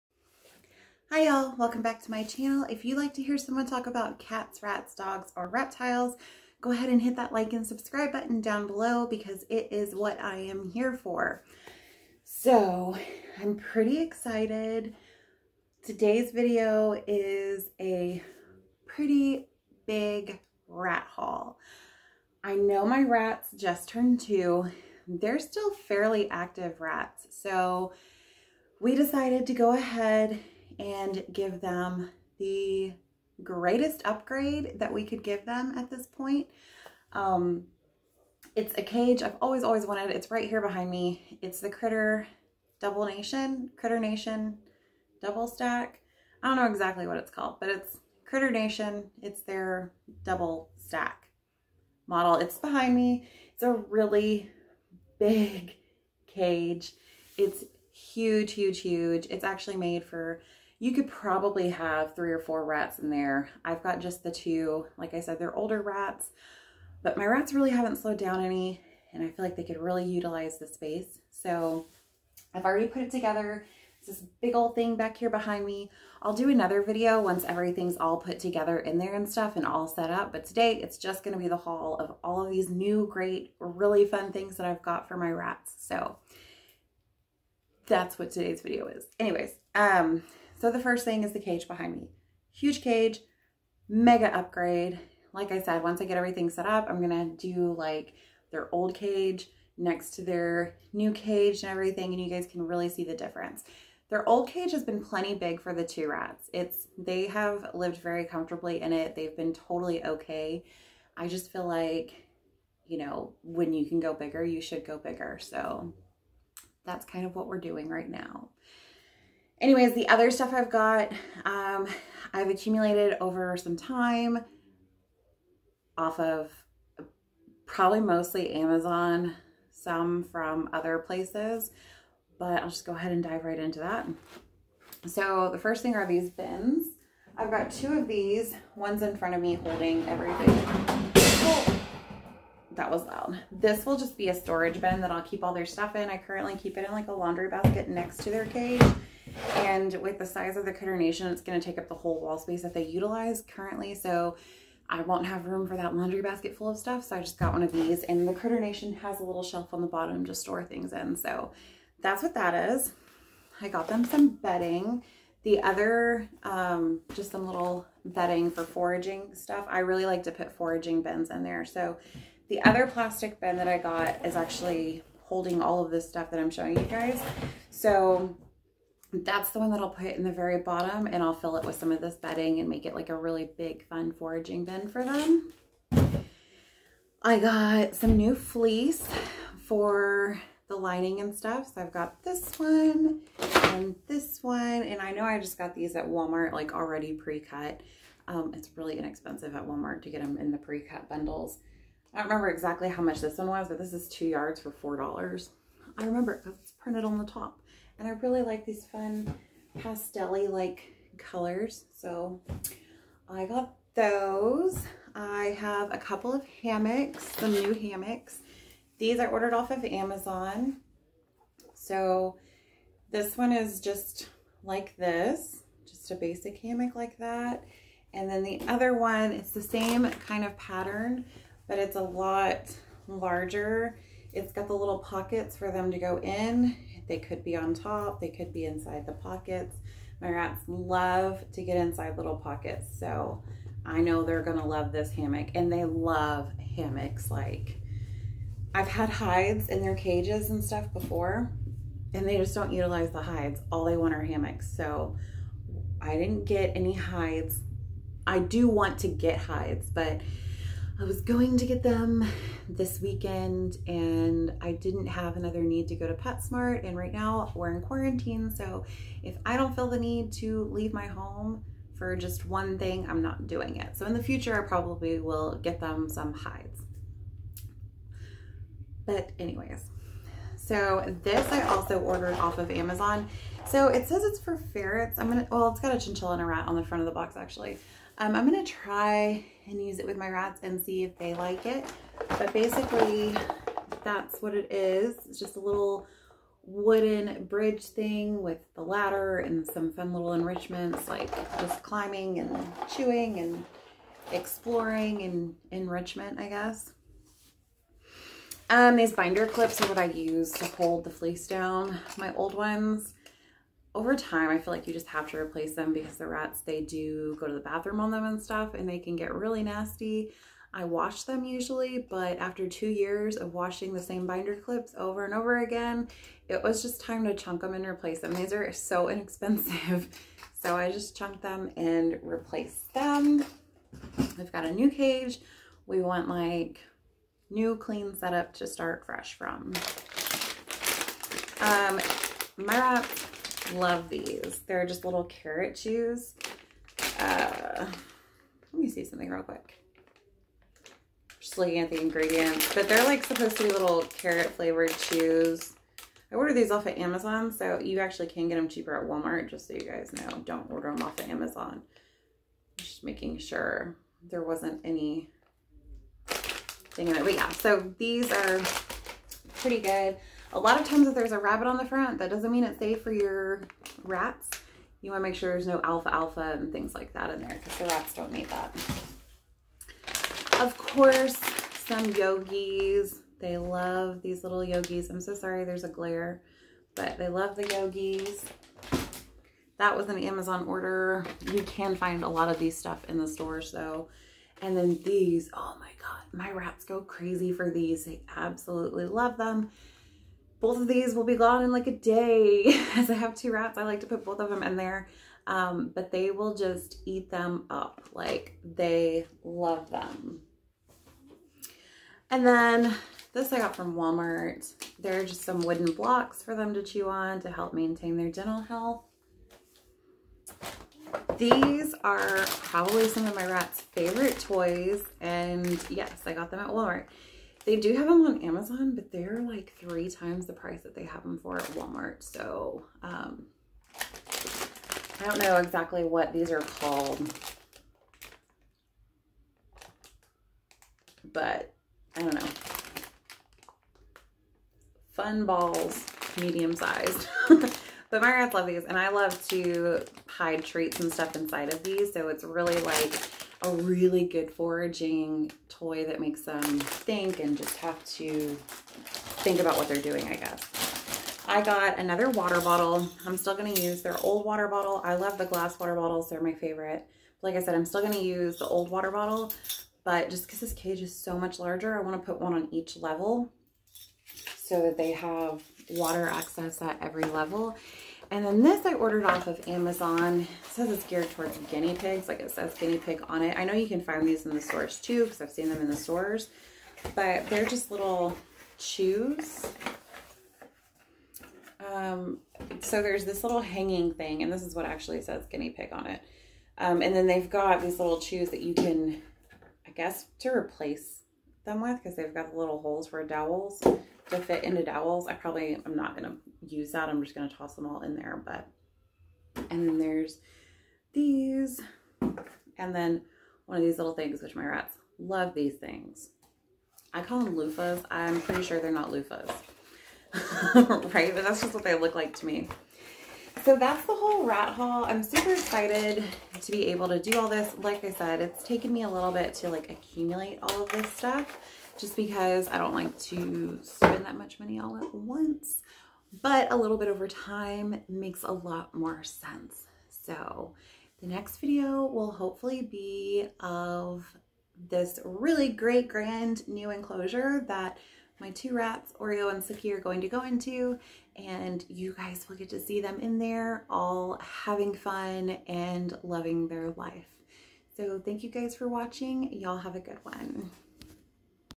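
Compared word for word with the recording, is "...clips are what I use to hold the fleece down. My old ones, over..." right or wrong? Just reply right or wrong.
right.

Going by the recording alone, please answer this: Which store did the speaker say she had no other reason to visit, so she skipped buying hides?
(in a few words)
PetSmart.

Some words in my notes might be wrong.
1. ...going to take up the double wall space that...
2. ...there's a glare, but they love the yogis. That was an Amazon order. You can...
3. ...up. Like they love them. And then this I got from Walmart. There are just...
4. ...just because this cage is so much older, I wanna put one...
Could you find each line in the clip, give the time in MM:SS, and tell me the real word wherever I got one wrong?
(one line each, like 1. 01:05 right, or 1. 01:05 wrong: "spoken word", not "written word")
1. 02:31 wrong: "whole", not "double"
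2. 06:25 right
3. 06:47 right
4. 07:50 wrong: "larger", not "older".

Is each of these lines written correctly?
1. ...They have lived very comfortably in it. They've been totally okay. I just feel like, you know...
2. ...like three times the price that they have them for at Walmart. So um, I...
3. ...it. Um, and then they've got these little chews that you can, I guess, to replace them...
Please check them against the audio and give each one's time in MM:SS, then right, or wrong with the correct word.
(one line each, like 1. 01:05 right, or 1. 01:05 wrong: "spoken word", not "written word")
1. 01:46 right
2. 07:09 right
3. 08:16 right.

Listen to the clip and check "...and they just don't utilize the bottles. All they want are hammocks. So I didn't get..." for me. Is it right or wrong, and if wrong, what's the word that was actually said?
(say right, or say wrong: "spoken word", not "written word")
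wrong: "hides", not "bottles".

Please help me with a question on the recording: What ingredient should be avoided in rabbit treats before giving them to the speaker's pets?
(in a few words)
Alfalfa.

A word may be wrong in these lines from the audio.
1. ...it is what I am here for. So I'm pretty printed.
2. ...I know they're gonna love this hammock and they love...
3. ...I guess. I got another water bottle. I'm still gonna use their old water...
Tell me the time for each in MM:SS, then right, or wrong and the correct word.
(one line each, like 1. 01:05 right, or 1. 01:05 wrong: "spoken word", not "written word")
1. 00:09 wrong: "excited", not "printed"
2. 04:03 right
3. 07:40 right.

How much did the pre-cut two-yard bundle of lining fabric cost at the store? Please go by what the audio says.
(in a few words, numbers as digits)
$4.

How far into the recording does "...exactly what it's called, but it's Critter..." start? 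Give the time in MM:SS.
00:46.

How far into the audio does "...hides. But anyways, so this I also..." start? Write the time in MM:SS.
04:36.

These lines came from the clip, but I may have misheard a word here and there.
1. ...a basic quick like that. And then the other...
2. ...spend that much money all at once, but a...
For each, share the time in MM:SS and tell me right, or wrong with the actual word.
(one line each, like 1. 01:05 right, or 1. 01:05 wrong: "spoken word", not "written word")
1. 03:46 wrong: "hammock", not "quick"
2. 08:53 right.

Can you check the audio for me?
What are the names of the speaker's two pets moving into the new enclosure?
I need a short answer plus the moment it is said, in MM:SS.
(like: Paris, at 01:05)
Oreo and Suki, at 09:09.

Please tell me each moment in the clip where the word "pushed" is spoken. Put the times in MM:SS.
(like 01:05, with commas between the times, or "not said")
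not said.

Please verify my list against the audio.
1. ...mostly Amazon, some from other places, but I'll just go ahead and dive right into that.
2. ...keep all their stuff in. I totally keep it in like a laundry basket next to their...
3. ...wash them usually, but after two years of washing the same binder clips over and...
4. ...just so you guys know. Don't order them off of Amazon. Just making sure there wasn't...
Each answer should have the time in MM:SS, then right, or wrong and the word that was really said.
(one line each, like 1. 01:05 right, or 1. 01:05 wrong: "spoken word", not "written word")
1. 02:07 right
2. 02:25 wrong: "currently", not "totally"
3. 05:20 right
4. 05:59 right.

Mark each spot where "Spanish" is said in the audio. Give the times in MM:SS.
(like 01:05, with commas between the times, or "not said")
not said.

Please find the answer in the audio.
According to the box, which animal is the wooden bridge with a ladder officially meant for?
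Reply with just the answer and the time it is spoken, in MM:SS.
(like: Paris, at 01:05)
Ferrets, at 04:44.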